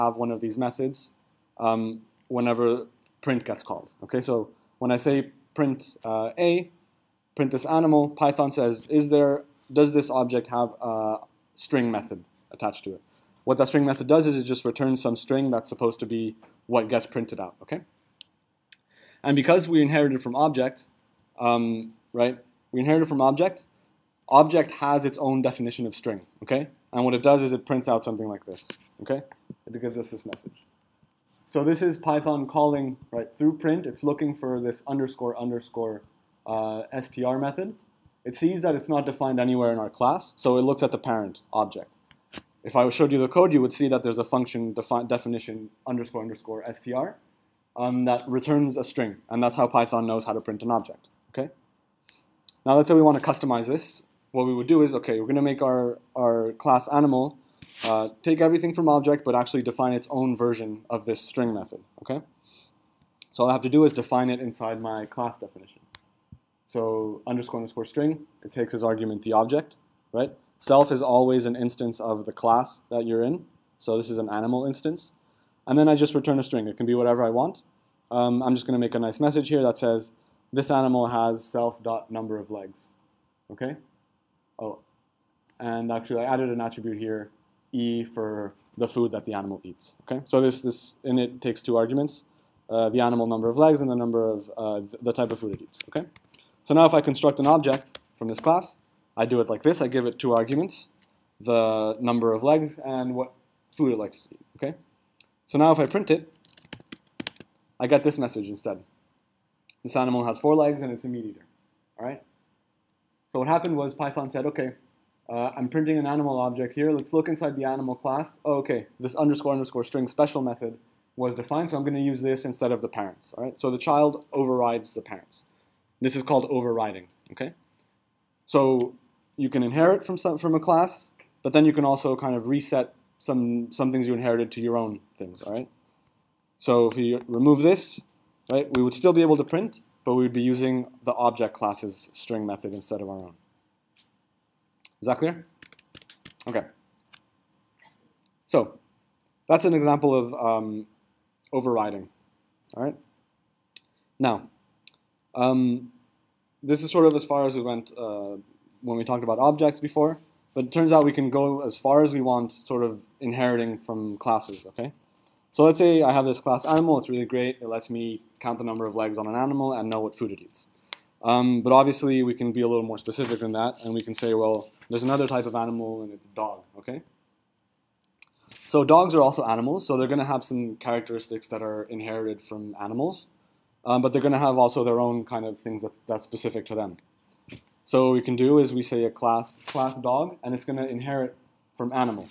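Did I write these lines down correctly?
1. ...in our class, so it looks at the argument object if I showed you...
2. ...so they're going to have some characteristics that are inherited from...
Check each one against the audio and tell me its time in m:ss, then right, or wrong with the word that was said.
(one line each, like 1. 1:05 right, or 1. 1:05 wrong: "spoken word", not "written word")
1. 0:39 wrong: "parent", not "argument"
2. 2:59 right.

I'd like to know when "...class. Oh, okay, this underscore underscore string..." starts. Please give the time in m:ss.
1:57.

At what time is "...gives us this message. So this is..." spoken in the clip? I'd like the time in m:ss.
0:29.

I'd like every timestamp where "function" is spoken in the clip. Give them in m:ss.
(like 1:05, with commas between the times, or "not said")
0:44.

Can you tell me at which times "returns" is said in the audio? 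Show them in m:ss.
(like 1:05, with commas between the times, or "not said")
0:14, 0:48, 1:16.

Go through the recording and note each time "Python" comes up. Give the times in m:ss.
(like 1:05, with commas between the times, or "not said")
0:08, 0:31, 0:49, 1:53.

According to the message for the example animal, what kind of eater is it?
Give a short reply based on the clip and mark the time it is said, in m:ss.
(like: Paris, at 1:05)
meat eater, at 1:51.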